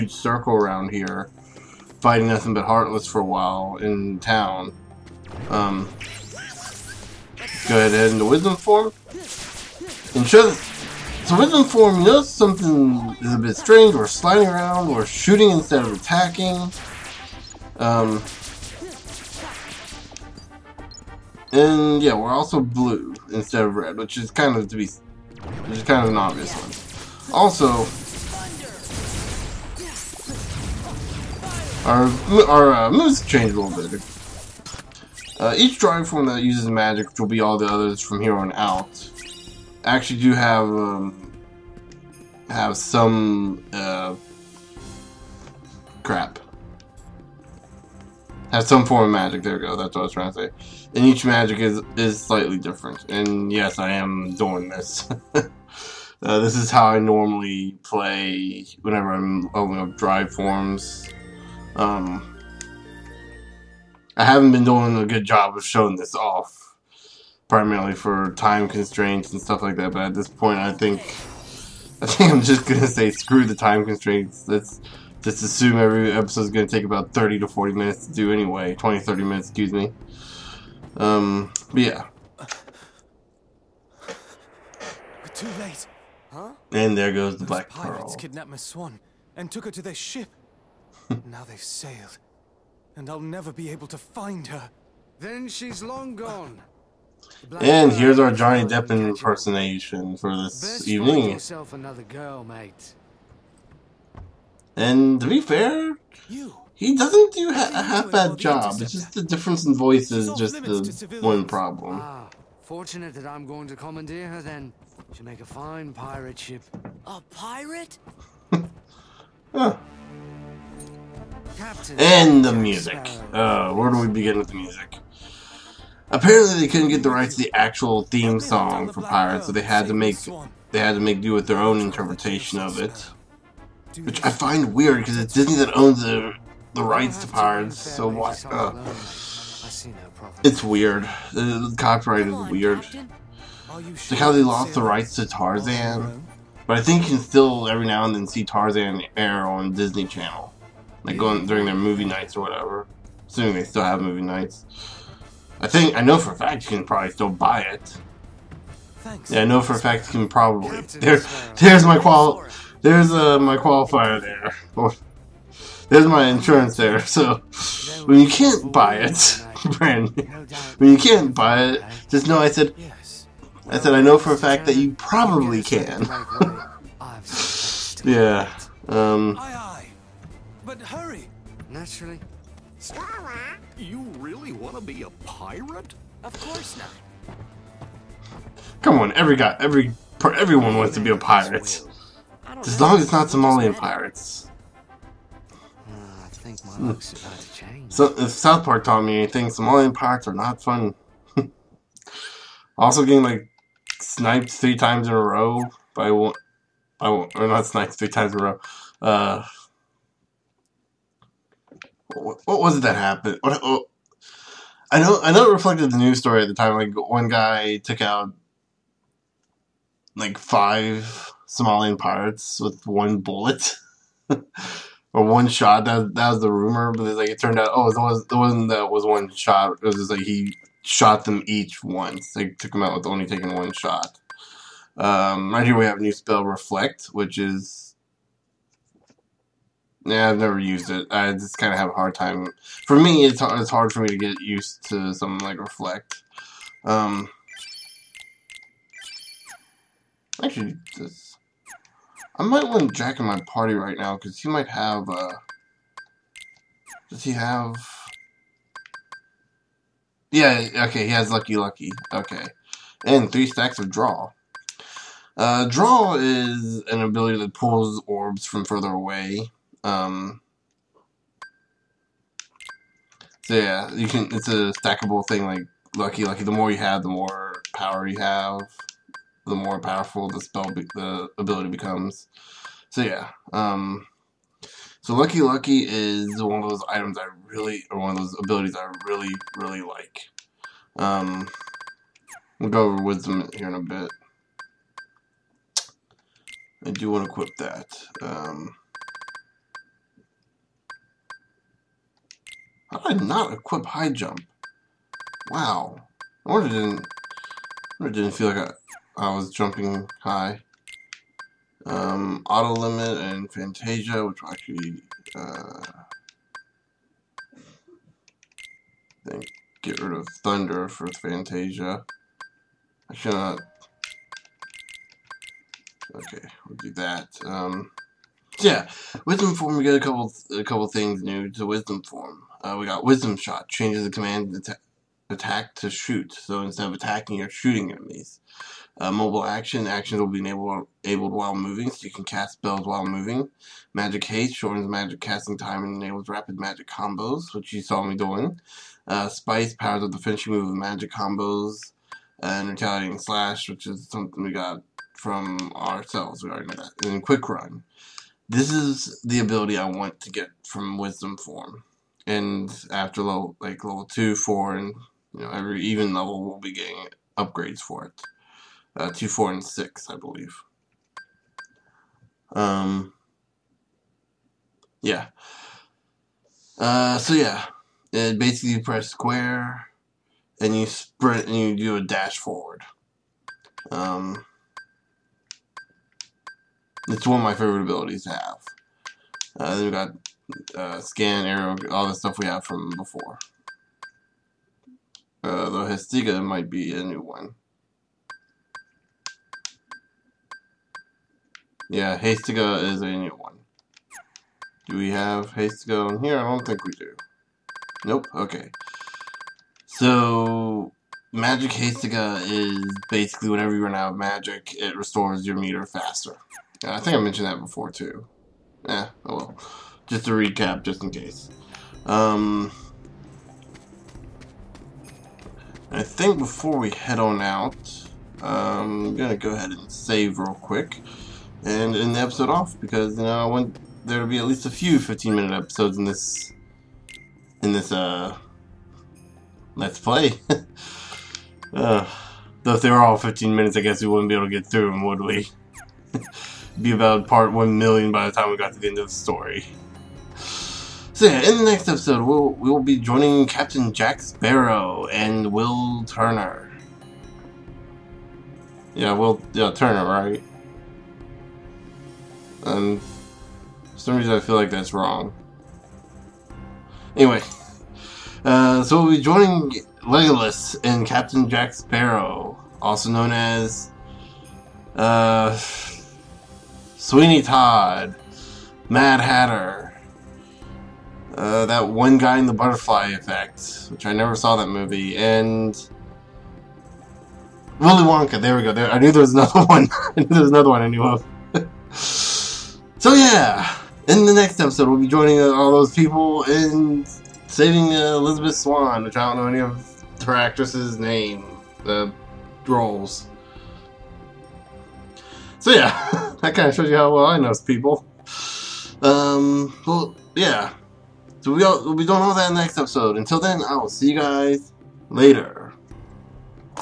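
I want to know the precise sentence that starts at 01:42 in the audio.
Girl, and to be fair, he doesn't do ha a half bad job.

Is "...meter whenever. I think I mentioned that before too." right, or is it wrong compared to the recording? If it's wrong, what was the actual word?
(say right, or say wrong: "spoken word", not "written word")
wrong: "faster", not "whenever".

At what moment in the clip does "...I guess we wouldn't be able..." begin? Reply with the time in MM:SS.
07:23.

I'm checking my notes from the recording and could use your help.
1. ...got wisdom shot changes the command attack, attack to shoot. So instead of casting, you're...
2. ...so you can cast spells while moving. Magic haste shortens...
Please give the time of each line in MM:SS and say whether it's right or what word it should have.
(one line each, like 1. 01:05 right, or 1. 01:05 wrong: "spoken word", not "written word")
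1. 05:32 wrong: "attacking", not "casting"
2. 05:41 right.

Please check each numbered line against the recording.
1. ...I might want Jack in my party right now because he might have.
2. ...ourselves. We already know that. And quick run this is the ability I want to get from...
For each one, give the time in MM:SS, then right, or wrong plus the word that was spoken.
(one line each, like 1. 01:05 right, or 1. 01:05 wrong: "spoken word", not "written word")
1. 04:12 right
2. 05:55 right.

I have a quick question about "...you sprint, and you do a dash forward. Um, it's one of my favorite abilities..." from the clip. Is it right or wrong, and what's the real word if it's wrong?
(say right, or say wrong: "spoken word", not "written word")
right.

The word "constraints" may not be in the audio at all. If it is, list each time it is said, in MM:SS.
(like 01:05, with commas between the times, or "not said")
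01:08, 01:13.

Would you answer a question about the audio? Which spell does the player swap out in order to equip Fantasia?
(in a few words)
Thunder.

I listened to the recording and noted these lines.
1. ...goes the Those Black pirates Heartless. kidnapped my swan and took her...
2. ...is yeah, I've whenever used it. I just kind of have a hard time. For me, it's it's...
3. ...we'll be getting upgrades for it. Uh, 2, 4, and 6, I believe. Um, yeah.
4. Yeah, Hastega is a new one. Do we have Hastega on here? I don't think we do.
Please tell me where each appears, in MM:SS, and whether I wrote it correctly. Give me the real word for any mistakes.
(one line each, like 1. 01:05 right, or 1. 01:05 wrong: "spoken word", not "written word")
1. 01:27 wrong: "Pearl", not "Heartless"
2. 03:57 wrong: "never", not "whenever"
3. 06:06 right
4. 06:41 right.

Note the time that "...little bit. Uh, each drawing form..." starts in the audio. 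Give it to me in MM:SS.
00:33.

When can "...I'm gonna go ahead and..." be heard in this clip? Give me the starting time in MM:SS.
07:09.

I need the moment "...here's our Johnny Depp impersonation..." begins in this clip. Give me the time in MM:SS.
01:37.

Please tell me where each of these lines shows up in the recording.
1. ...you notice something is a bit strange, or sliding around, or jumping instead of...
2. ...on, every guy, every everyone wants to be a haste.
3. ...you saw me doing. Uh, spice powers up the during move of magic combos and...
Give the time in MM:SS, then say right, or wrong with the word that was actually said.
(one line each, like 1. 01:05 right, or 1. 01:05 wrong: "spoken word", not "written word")
1. 00:11 wrong: "shooting", not "jumping"
2. 03:08 wrong: "pirate", not "haste"
3. 05:47 wrong: "finishing", not "during".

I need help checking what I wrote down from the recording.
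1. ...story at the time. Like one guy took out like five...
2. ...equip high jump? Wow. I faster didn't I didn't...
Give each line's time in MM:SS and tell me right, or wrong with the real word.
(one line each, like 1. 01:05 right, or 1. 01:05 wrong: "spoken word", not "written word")
1. 03:36 right
2. 05:03 wrong: "wonder", not "faster".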